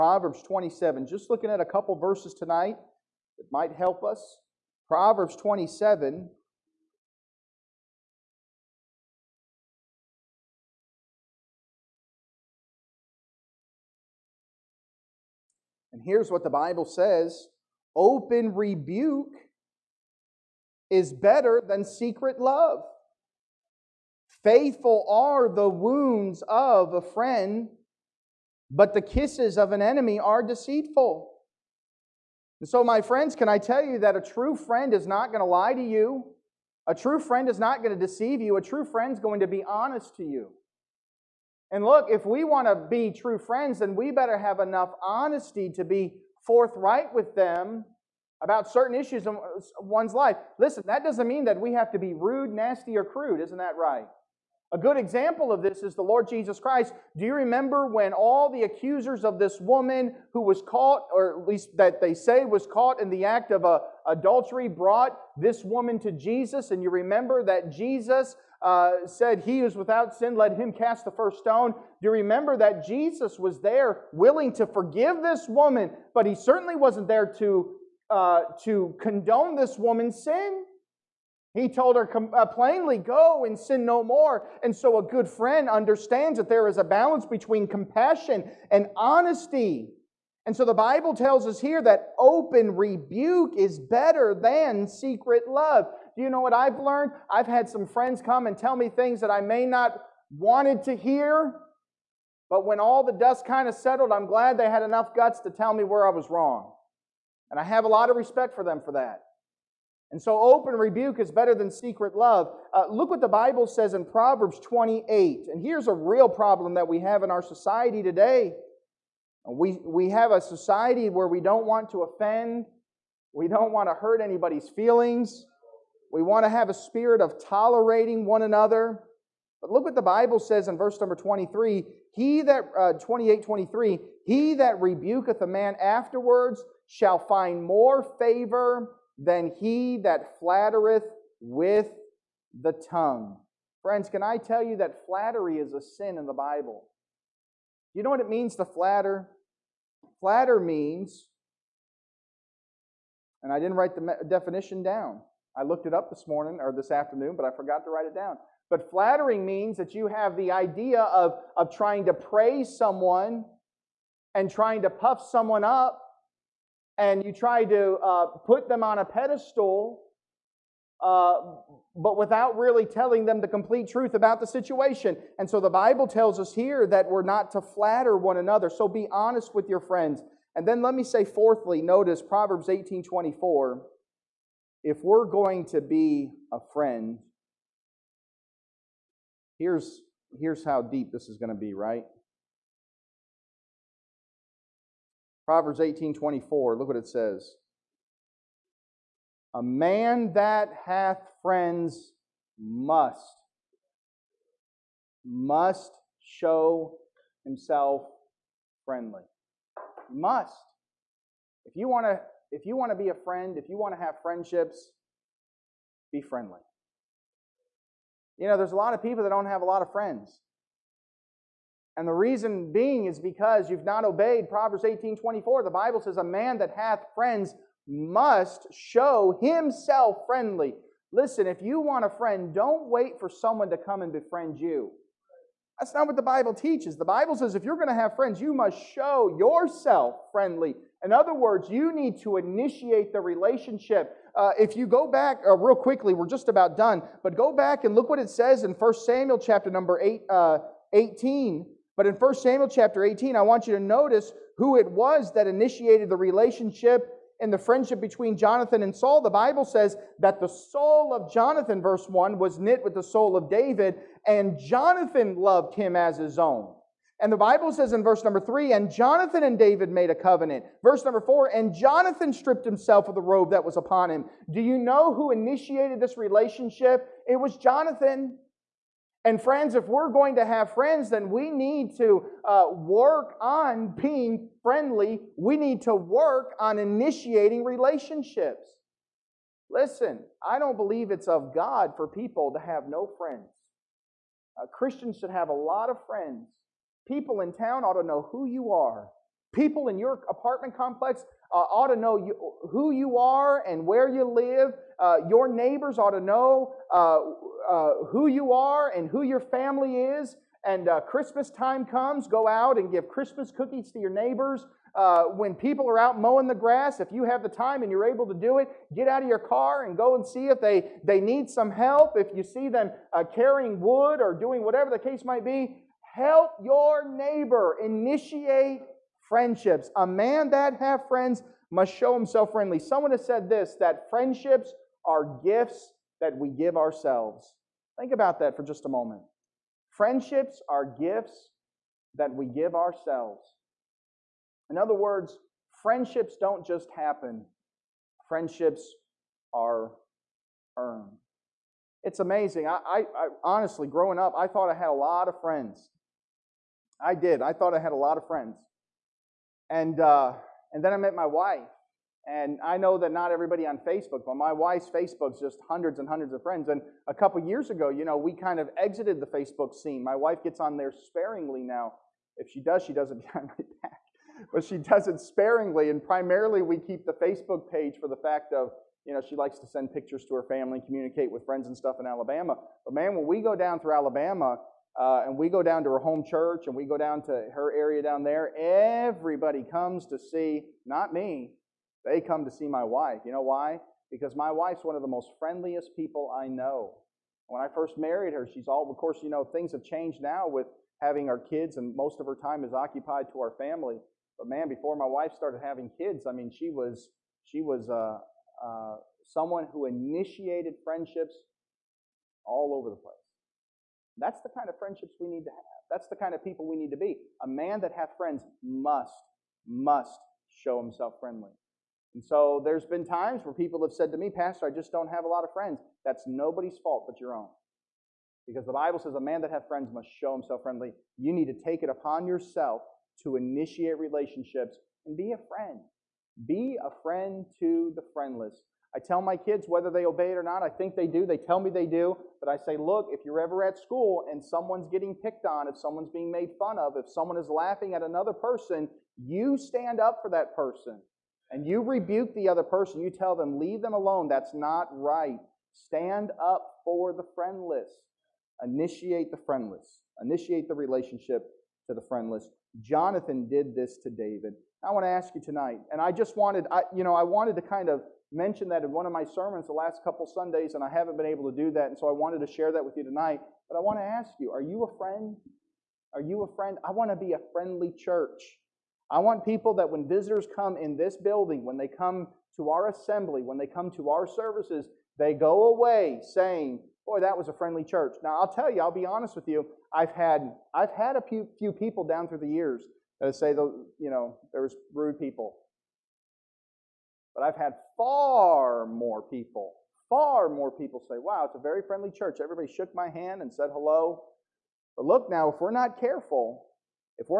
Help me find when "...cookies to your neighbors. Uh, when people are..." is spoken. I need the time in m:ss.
5:13.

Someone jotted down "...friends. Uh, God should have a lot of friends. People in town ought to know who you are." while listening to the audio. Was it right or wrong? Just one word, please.
wrong.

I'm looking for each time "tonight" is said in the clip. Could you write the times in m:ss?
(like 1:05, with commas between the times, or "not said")
0:02, 7:45, 7:53.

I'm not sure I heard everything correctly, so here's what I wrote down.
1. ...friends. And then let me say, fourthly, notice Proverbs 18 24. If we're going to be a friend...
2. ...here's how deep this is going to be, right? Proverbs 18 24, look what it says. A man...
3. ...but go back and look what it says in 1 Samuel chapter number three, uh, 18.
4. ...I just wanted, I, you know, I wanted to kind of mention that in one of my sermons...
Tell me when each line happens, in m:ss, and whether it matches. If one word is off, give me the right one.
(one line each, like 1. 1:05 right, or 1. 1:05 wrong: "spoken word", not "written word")
1. 2:59 right
2. 3:10 right
3. 4:07 wrong: "eight", not "three"
4. 7:46 right.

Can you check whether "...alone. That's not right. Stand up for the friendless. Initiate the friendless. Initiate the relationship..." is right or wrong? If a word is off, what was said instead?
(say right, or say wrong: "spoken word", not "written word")
right.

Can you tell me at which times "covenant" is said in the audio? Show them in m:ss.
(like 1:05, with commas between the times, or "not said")
4:30.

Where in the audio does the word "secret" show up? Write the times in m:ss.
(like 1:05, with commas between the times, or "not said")
0:21, 1:34, 1:51.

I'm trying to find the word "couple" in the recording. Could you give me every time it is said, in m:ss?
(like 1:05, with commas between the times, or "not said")
0:01, 6:07, 7:50.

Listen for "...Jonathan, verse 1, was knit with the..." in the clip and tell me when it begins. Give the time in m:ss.
4:21.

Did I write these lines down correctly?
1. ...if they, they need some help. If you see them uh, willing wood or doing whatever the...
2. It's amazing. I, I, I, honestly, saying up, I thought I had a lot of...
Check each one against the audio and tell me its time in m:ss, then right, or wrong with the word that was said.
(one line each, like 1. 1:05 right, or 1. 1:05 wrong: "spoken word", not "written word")
1. 5:20 wrong: "carrying", not "willing"
2. 5:52 wrong: "growing", not "saying".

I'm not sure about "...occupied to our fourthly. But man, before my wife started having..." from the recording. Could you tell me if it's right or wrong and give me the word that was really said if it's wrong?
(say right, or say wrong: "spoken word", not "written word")
wrong: "family", not "fourthly".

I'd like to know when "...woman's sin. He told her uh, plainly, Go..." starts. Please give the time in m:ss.
1:19.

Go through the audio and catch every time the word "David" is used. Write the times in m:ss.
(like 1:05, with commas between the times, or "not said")
4:23, 4:29, 7:44.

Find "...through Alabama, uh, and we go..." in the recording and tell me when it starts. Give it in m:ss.
6:23.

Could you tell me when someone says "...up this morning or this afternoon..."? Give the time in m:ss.
2:35.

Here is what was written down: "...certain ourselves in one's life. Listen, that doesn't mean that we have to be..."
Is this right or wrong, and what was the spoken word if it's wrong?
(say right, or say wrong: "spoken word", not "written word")
wrong: "issues", not "ourselves".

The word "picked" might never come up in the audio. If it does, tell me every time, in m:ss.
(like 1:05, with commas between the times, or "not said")
7:25.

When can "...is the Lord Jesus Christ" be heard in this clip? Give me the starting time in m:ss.
0:55.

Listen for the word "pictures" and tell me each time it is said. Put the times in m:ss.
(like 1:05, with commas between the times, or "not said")
6:19.